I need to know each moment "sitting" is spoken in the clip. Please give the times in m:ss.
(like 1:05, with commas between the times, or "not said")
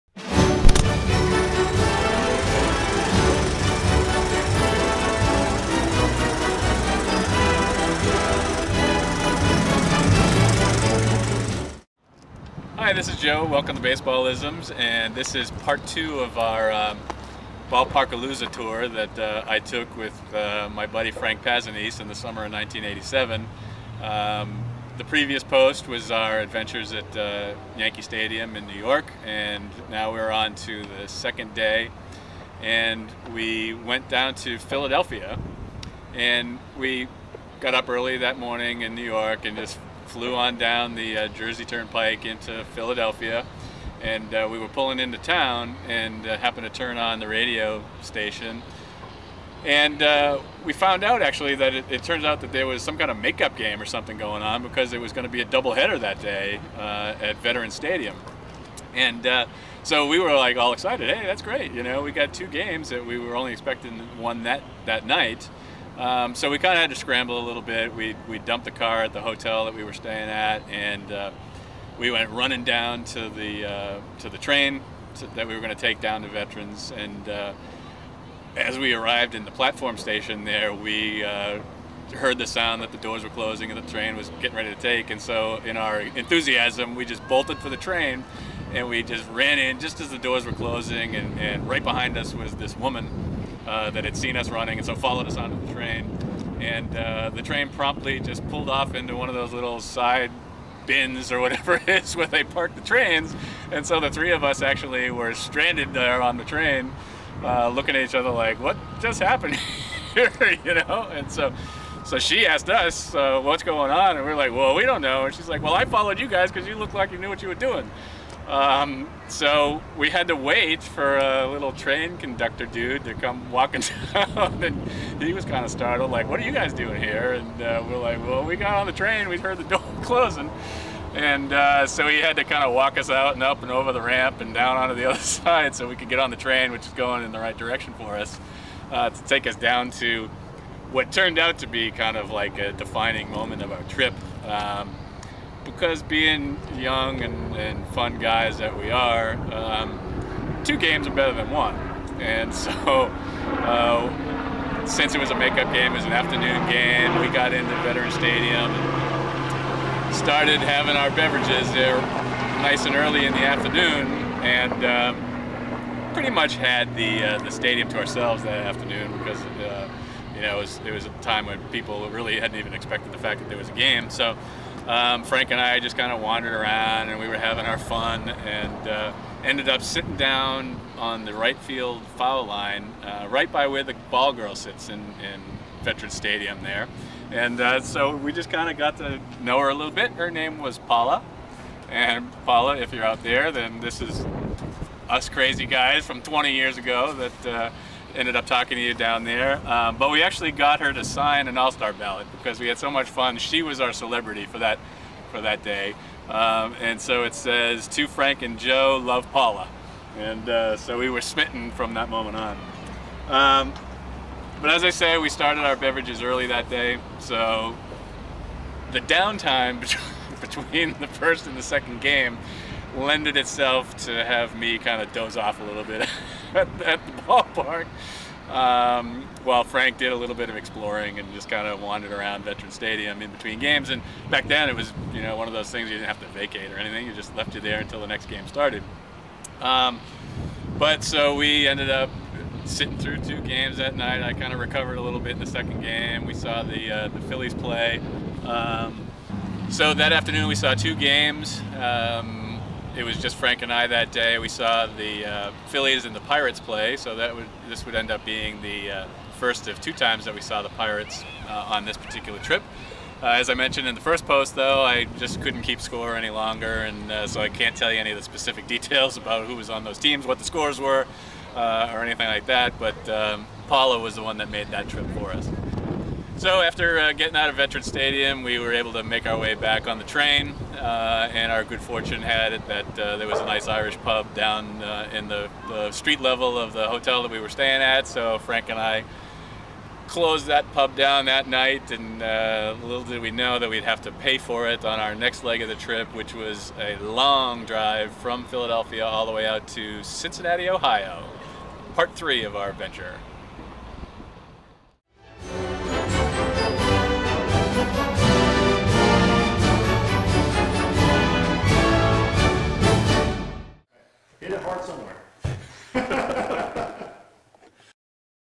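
2:59, 4:02.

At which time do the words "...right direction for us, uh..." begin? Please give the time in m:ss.
2:17.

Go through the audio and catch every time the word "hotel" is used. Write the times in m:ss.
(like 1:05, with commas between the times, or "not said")
1:09, 4:46.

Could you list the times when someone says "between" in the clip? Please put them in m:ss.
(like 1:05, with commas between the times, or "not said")
3:40, 3:53.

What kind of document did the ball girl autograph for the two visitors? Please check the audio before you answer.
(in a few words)
all-star ballot.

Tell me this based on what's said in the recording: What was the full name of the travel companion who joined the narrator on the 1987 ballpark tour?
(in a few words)
Frank Pazanese.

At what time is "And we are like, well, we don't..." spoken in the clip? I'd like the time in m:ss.
1:54.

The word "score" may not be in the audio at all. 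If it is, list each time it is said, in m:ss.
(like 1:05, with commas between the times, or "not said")
4:25, 4:30.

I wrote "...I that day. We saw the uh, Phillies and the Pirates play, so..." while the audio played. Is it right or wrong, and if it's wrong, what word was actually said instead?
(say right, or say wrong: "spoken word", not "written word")
right.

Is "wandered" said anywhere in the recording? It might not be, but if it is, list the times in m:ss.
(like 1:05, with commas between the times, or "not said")
2:56, 3:51.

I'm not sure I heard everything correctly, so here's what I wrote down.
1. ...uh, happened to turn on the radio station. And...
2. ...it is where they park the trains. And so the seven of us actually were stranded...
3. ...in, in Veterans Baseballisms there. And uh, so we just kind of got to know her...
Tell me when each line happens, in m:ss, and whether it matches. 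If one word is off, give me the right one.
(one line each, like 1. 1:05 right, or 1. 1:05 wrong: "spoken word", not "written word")
1. 0:46 right
2. 1:41 wrong: "three", not "seven"
3. 3:04 wrong: "Stadium", not "Baseballisms".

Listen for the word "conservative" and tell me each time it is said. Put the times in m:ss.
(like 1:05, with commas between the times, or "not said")
not said.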